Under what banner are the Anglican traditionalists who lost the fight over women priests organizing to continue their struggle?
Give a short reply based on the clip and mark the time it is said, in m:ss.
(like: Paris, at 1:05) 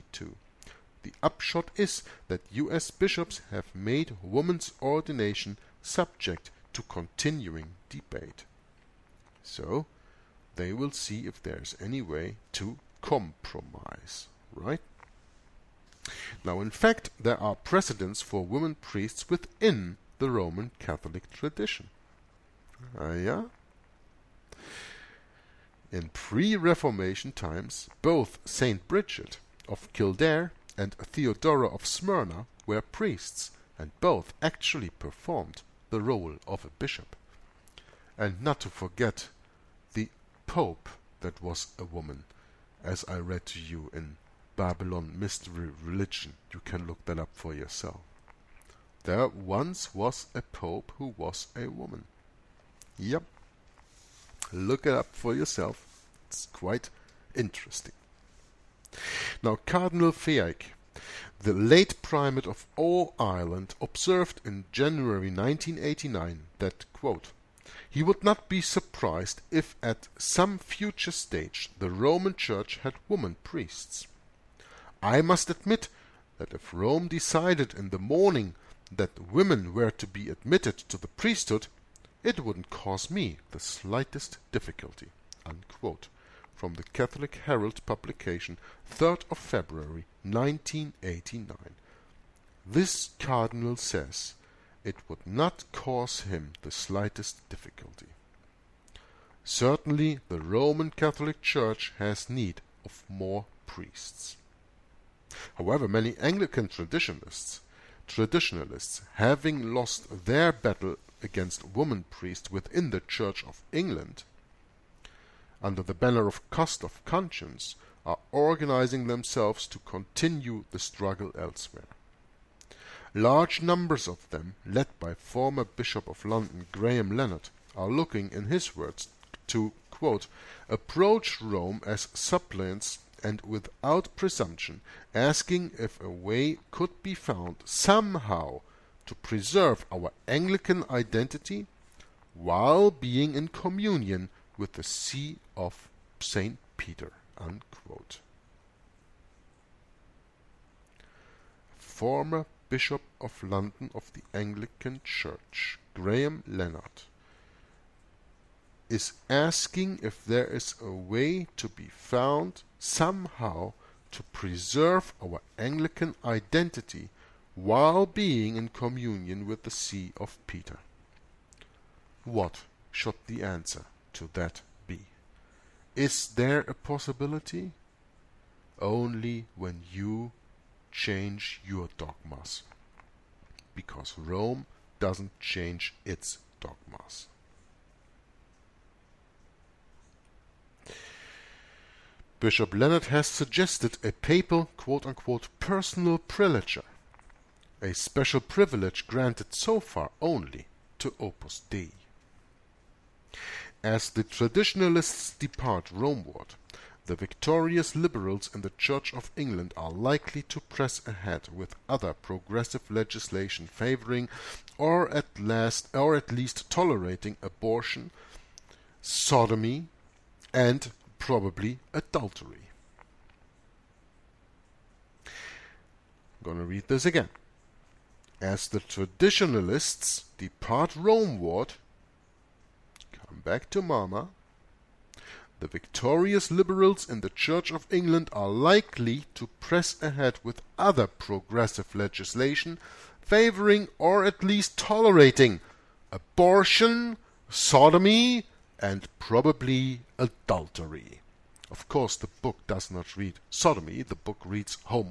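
Cost of Conscience, at 1:56.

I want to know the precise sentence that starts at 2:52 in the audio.
What should the answer to that be, Is there a possibility?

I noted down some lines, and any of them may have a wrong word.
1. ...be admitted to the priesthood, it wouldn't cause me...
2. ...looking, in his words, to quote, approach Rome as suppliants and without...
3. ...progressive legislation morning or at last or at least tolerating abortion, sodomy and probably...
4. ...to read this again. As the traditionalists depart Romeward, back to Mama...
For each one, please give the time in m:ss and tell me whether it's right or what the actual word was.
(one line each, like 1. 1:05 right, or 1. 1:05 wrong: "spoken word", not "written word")
1. 1:20 right
2. 2:07 right
3. 3:32 wrong: "favouring", not "morning"
4. 3:46 right.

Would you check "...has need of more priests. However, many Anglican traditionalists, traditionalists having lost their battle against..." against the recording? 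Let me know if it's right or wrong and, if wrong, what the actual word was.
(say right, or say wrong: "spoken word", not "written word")
right.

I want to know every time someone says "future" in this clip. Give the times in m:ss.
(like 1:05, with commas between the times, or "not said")
1:10.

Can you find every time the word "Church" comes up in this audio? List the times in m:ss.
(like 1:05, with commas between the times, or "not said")
1:12, 1:41, 1:53, 2:35, 3:28, 3:57.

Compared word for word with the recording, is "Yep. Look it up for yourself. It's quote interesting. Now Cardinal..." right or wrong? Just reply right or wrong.
wrong.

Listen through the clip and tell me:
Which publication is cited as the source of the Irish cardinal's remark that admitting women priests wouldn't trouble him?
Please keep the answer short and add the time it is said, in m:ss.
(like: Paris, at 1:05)
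Catholic Herald, at 1:26.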